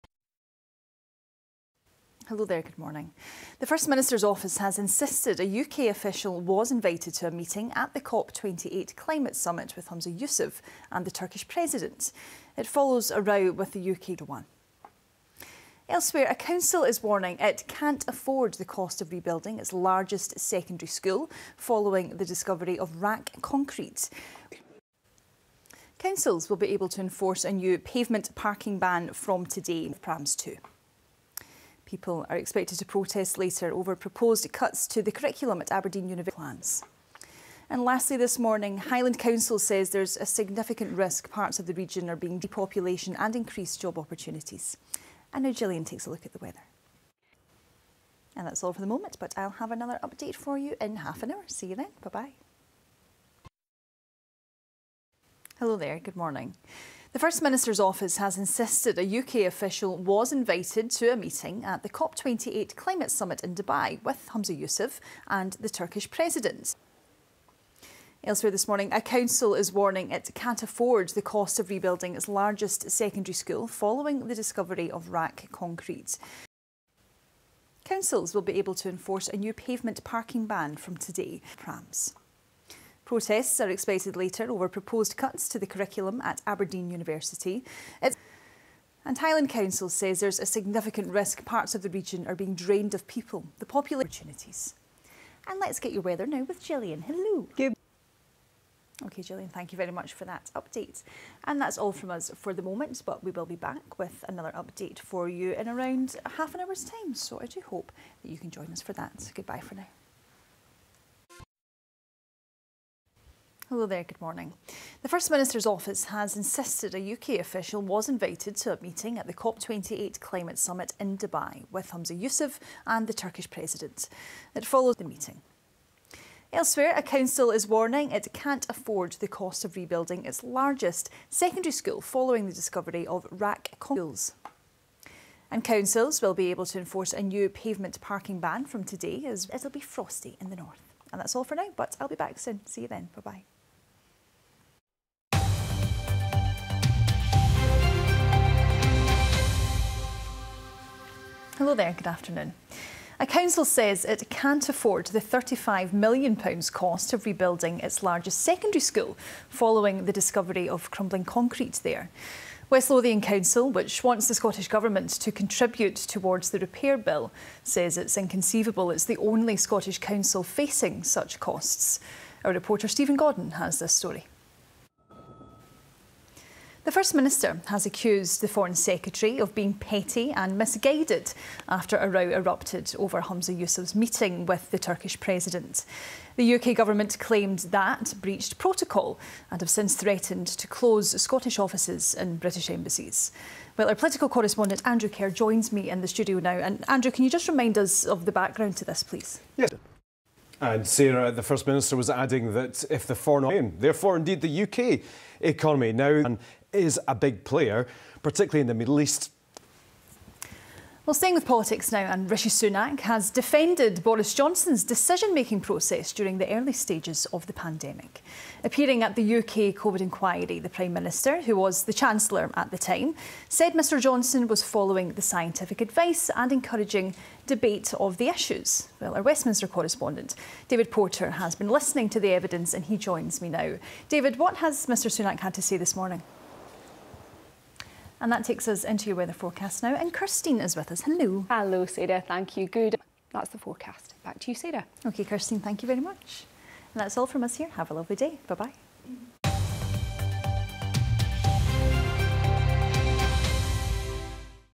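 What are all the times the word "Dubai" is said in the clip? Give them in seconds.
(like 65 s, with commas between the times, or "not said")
63 s, 121 s.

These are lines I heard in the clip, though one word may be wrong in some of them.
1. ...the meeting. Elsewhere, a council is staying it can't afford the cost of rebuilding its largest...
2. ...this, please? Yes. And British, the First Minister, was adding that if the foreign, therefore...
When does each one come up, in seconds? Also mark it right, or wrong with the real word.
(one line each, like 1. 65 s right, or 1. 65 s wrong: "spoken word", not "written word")
1. 124 s wrong: "warning", not "staying"
2. 198 s wrong: "Sarah", not "British".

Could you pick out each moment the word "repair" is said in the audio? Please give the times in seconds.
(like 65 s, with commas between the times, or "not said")
166 s.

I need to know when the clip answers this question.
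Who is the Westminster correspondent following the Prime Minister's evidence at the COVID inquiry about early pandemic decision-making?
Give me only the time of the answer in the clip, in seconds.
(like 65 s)
230 s.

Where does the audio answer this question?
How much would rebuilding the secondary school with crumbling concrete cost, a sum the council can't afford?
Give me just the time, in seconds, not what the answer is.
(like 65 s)
155 s.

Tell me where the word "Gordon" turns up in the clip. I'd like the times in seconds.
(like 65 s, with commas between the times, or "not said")
173 s.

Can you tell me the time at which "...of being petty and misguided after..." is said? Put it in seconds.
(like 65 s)
179 s.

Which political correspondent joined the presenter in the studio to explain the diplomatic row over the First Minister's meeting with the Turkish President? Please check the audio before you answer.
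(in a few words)
Andrew Kerr.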